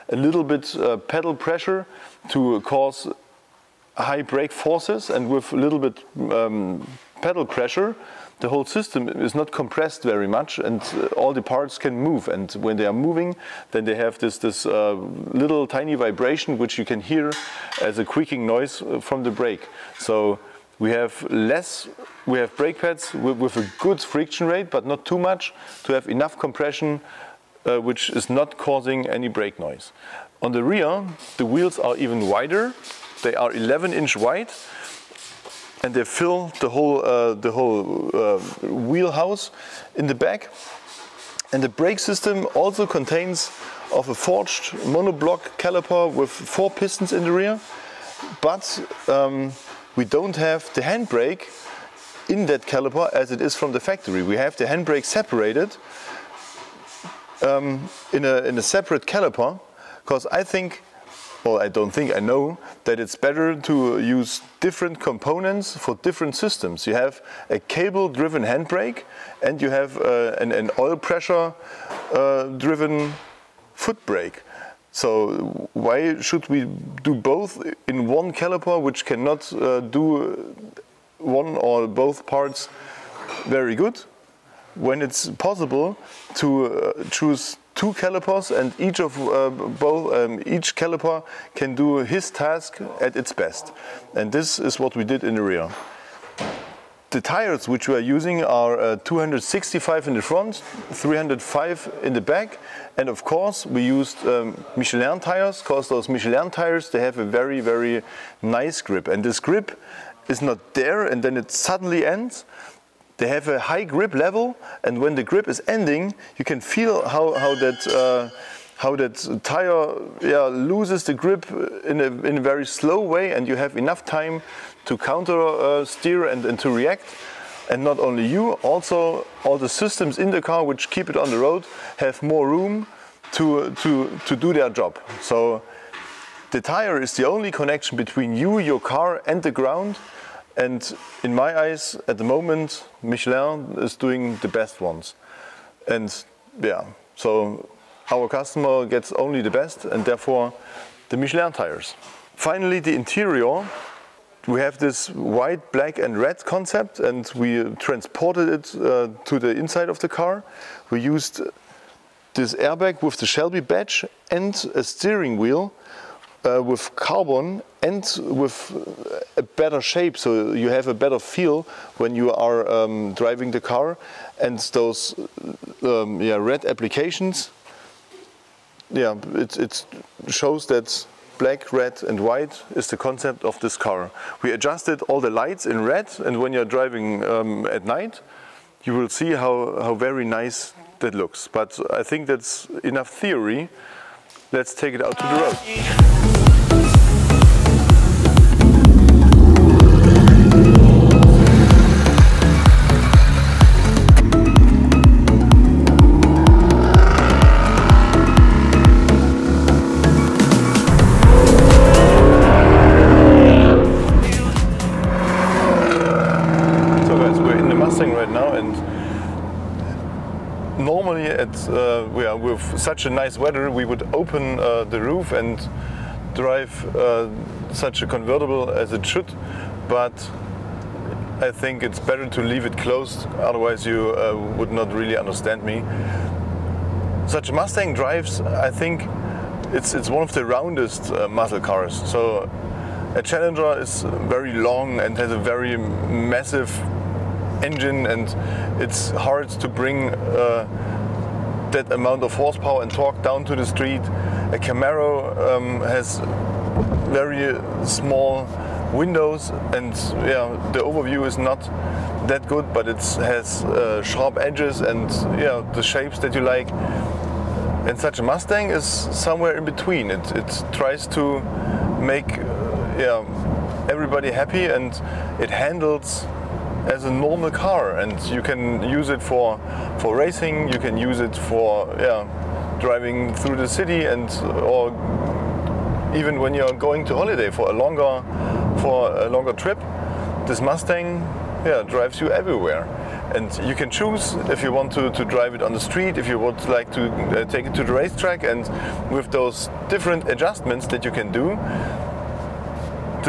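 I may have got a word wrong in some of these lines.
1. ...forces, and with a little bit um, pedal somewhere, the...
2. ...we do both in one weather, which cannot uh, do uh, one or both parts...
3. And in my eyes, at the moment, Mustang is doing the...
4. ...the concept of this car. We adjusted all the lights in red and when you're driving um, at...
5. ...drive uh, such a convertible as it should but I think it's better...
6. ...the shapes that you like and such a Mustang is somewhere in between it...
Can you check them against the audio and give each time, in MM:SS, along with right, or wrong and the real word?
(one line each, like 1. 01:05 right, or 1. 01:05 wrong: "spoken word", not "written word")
1. 00:04 wrong: "pressure", not "somewhere"
2. 01:16 wrong: "caliper", not "weather"
3. 02:20 wrong: "Michelin", not "Mustang"
4. 03:02 right
5. 03:46 right
6. 04:25 right.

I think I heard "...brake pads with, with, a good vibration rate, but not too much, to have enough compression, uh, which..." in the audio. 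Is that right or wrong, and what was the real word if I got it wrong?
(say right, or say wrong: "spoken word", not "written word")
wrong: "friction", not "vibration".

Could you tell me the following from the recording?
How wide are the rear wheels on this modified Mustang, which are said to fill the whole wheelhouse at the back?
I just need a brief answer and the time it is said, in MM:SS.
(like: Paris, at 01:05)
11 inch, at 00:33.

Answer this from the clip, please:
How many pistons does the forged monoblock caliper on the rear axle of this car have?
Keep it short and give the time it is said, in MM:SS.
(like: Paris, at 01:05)
4, at 00:46.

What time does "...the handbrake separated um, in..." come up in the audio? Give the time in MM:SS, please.
00:54.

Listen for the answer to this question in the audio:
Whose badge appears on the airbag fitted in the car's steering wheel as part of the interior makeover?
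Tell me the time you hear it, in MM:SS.
02:43.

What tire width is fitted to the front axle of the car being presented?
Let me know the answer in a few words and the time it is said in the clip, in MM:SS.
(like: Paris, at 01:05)
265, at 01:38.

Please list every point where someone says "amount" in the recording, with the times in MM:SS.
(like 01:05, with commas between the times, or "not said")
04:11.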